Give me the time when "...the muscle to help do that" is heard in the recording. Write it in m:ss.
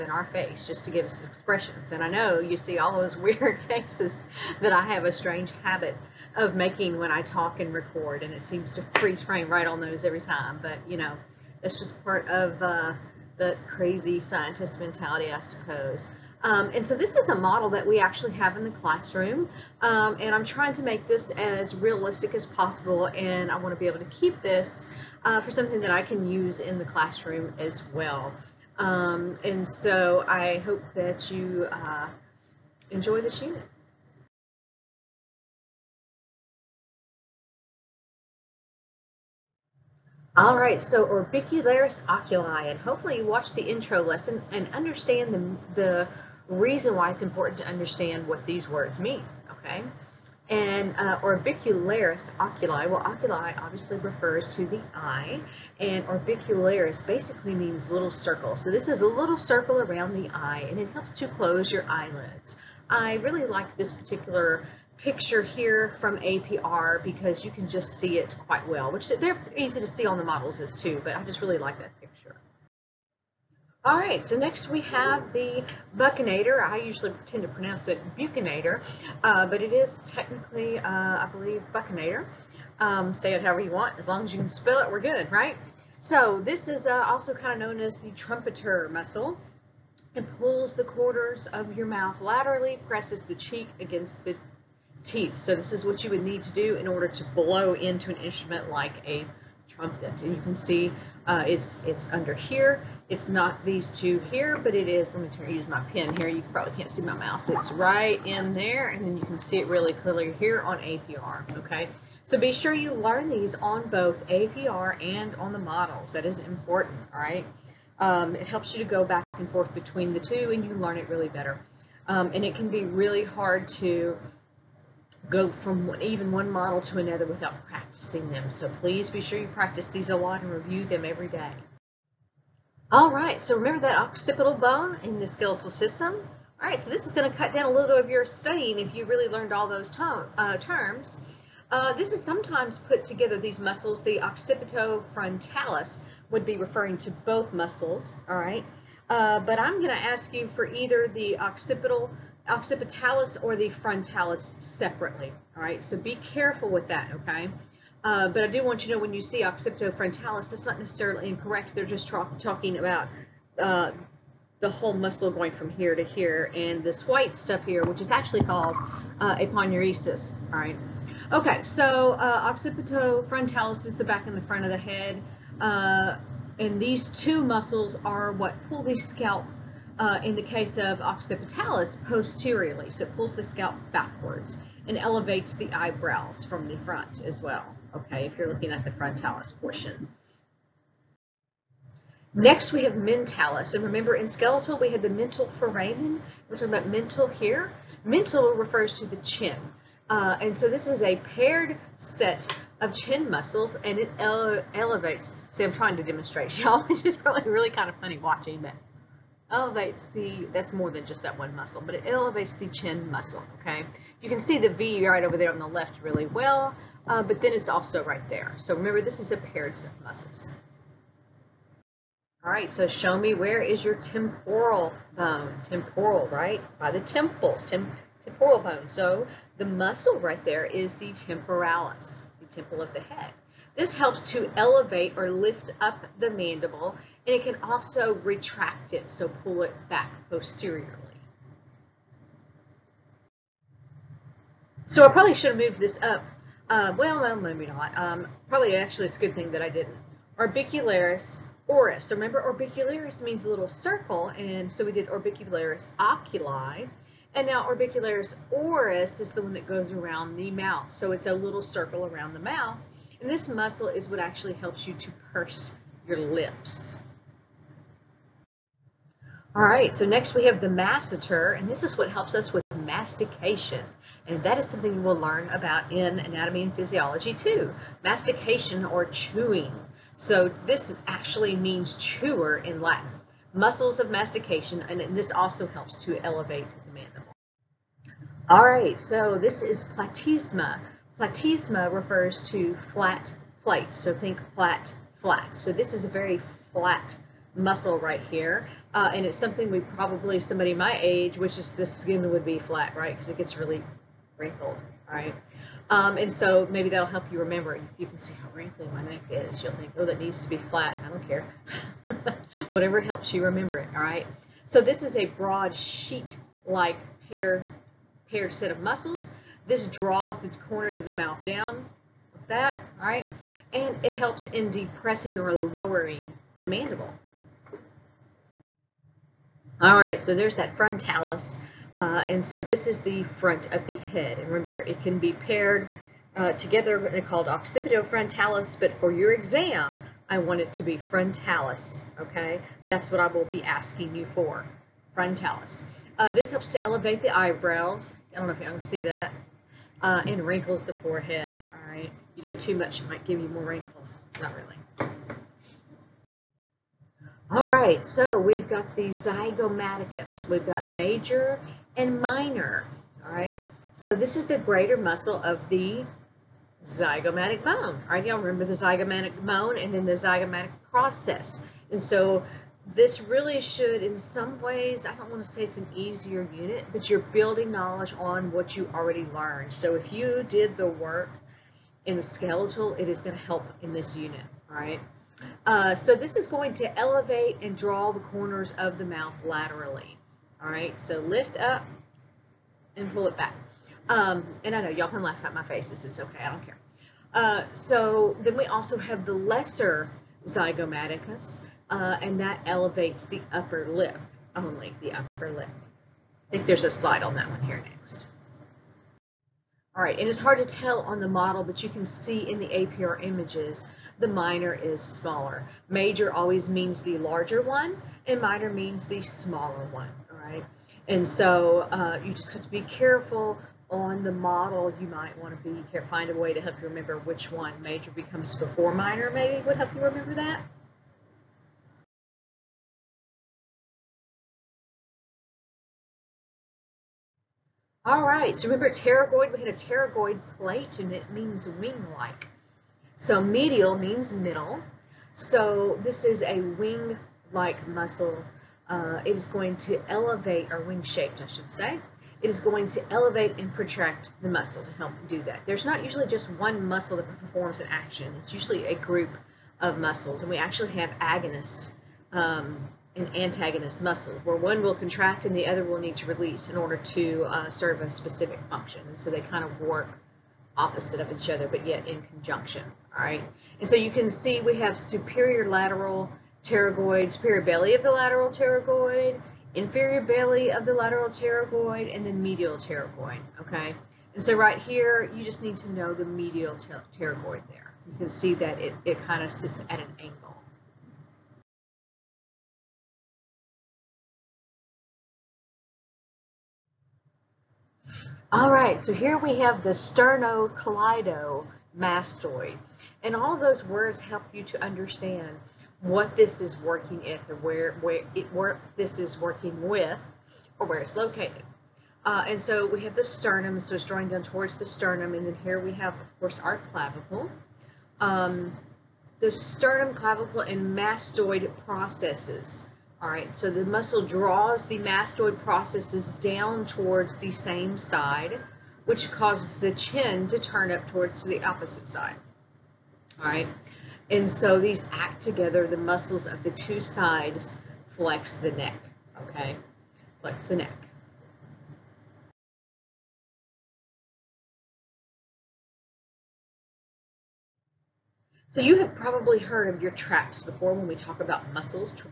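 7:34.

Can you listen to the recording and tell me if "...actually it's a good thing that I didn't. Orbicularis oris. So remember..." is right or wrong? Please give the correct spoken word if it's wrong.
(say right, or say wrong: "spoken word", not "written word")
right.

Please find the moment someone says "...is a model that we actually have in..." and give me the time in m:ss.
0:17.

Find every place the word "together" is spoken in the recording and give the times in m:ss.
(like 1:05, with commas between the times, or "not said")
2:23, 5:36, 8:55.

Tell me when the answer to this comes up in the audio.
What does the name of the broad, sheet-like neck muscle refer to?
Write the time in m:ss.
4:52.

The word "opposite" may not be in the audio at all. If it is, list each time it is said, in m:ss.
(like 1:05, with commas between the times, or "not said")
7:50, 8:51.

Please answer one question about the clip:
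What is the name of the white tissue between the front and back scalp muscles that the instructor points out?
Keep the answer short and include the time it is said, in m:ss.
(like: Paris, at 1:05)
aponeurosis, at 2:49.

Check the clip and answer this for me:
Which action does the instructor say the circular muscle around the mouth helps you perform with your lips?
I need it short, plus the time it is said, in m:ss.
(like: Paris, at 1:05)
purse your lips, at 4:25.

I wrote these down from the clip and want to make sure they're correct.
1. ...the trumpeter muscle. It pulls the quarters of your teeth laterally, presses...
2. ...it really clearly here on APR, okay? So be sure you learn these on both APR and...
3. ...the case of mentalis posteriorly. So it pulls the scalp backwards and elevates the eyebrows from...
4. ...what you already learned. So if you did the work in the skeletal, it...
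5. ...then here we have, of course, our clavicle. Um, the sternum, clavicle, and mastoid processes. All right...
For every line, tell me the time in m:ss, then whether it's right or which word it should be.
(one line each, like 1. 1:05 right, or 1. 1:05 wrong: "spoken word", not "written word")
1. 1:27 wrong: "mouth", not "teeth"
2. 1:49 right
3. 3:00 wrong: "occipitalis", not "mentalis"
4. 6:18 right
5. 8:35 right.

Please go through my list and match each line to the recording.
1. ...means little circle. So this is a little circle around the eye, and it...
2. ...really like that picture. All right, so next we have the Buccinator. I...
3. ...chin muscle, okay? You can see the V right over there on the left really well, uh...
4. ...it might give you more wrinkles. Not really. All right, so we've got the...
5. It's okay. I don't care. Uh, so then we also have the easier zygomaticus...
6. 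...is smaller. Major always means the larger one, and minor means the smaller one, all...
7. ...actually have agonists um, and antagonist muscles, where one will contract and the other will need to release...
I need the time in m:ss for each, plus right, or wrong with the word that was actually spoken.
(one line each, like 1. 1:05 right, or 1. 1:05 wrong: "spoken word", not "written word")
1. 0:57 right
2. 1:11 right
3. 3:32 right
4. 5:53 right
5. 6:36 wrong: "lesser", not "easier"
6. 6:54 right
7. 7:40 right.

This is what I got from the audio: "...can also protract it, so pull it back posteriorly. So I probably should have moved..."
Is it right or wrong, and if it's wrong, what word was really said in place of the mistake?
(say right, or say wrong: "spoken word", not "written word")
wrong: "retract", not "protract".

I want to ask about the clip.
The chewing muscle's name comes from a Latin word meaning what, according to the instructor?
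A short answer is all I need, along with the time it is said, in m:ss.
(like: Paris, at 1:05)
chewer, at 4:41.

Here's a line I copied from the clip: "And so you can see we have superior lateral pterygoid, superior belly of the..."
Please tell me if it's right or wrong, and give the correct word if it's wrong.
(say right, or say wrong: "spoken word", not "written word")
right.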